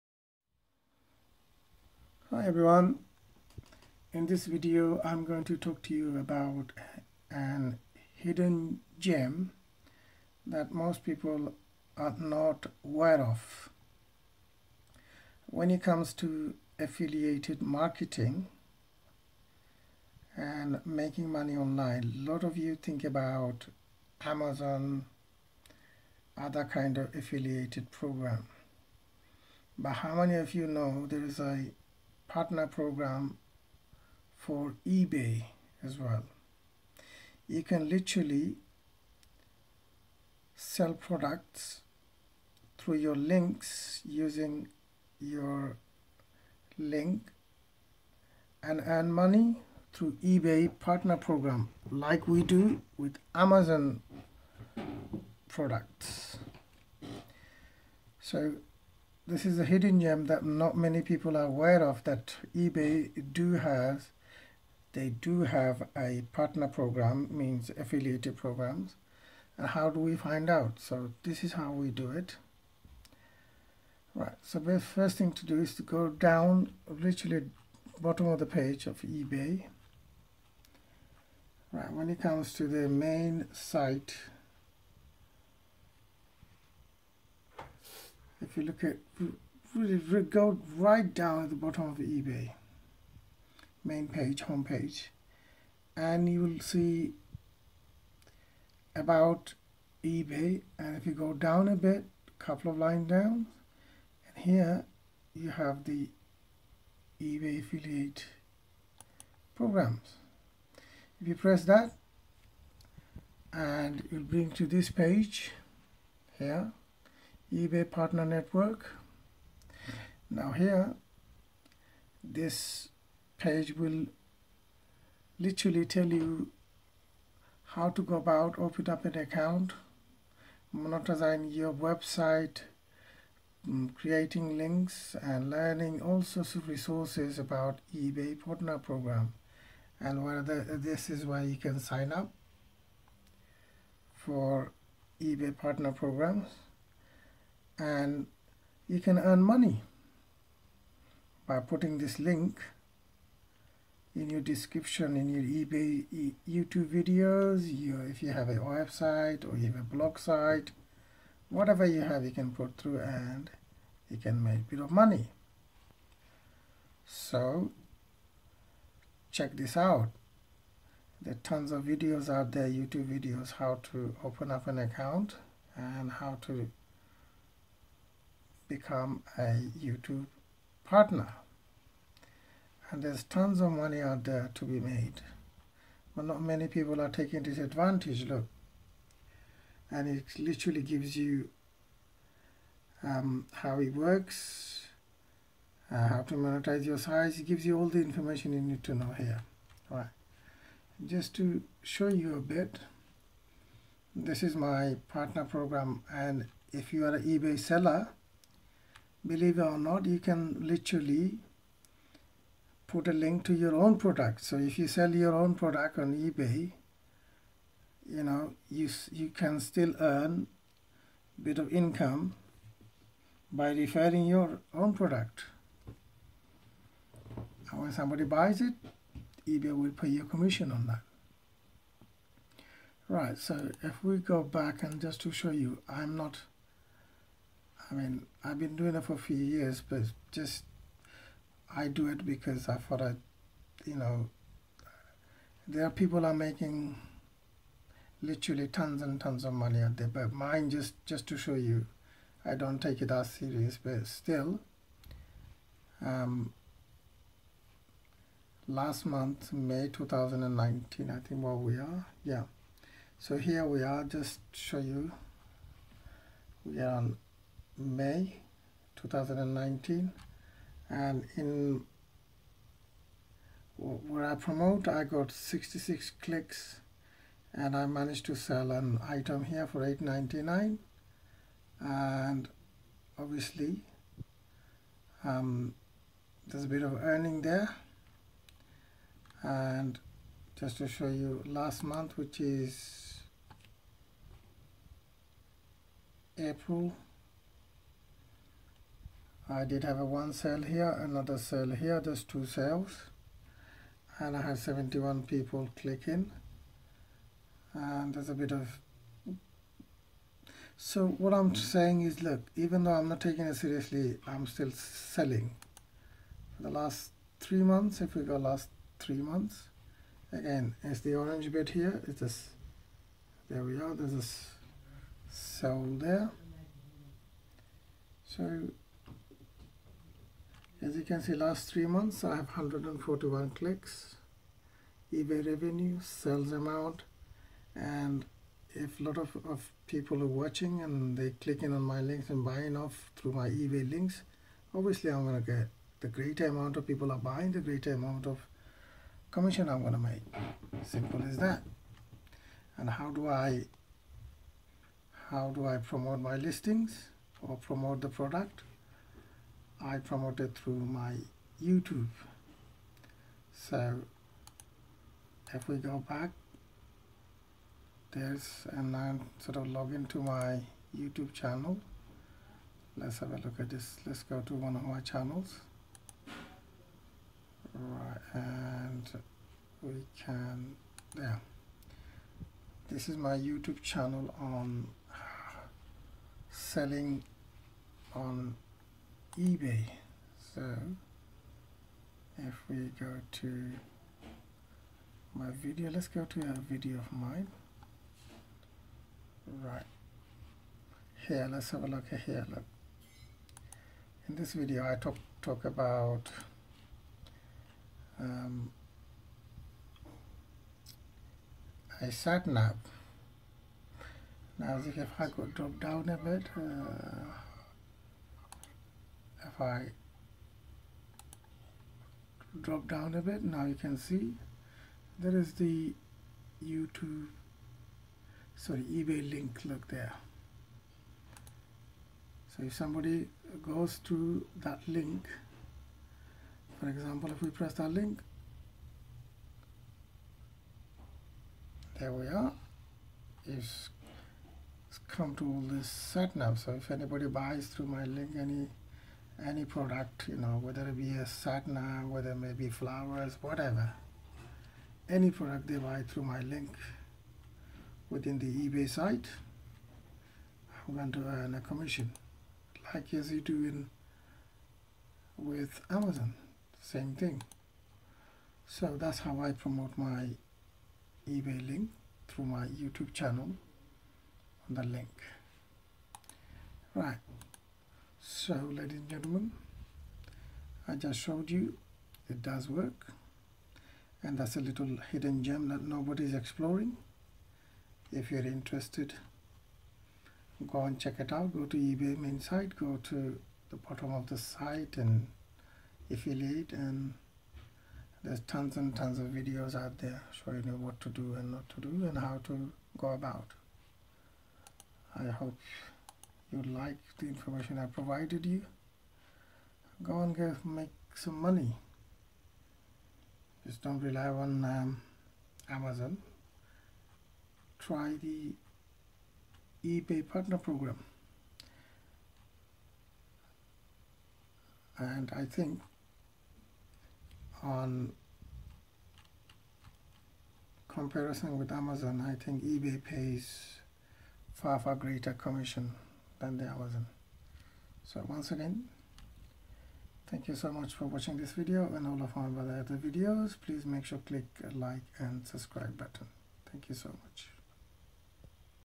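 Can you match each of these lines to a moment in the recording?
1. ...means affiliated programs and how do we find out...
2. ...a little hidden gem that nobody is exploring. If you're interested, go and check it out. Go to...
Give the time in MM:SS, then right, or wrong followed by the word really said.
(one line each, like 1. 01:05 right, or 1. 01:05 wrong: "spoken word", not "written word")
1. 01:07 right
2. 08:04 right.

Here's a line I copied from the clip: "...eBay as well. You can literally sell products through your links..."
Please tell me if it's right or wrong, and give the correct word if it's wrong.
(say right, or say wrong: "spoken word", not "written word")
right.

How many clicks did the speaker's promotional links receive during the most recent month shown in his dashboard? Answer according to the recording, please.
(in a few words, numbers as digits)
66.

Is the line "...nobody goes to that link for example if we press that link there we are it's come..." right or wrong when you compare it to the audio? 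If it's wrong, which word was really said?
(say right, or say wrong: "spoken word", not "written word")
wrong: "somebody", not "nobody".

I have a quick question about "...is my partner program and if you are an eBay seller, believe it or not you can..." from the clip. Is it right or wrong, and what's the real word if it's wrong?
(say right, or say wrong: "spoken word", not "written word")
right.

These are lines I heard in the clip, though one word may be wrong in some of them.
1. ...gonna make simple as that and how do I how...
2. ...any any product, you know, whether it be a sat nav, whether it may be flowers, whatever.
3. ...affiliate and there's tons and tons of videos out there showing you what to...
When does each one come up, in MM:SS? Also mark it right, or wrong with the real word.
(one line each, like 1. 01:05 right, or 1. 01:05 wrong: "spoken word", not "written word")
1. 05:49 right
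2. 07:28 right
3. 08:16 right.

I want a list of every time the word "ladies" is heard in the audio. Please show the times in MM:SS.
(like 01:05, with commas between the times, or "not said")
07:58.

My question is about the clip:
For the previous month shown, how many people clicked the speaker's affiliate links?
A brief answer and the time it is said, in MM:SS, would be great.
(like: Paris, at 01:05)
71, at 05:04.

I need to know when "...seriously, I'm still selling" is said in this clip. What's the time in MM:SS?
05:13.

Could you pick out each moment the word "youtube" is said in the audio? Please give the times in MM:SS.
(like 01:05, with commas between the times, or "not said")
02:36, 02:52, 02:59, 06:01, 06:10, 06:23, 07:06, 07:52.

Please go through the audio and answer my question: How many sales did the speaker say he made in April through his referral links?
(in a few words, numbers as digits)
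2.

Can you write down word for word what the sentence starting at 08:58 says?
So once again, thank you so much for watching this video and all of my other videos.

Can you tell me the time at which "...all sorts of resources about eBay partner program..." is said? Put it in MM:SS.
02:16.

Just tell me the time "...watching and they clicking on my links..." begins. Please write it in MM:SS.
05:40.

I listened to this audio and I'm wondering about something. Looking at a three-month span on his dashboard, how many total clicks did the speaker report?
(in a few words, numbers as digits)
141.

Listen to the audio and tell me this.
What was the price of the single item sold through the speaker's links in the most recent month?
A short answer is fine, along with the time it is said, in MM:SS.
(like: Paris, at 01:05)
8.99, at 04:39.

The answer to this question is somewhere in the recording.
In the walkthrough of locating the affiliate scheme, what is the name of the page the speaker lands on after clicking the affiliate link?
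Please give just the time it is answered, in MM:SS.
01:57.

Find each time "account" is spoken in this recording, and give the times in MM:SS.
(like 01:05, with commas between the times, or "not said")
02:09, 02:54.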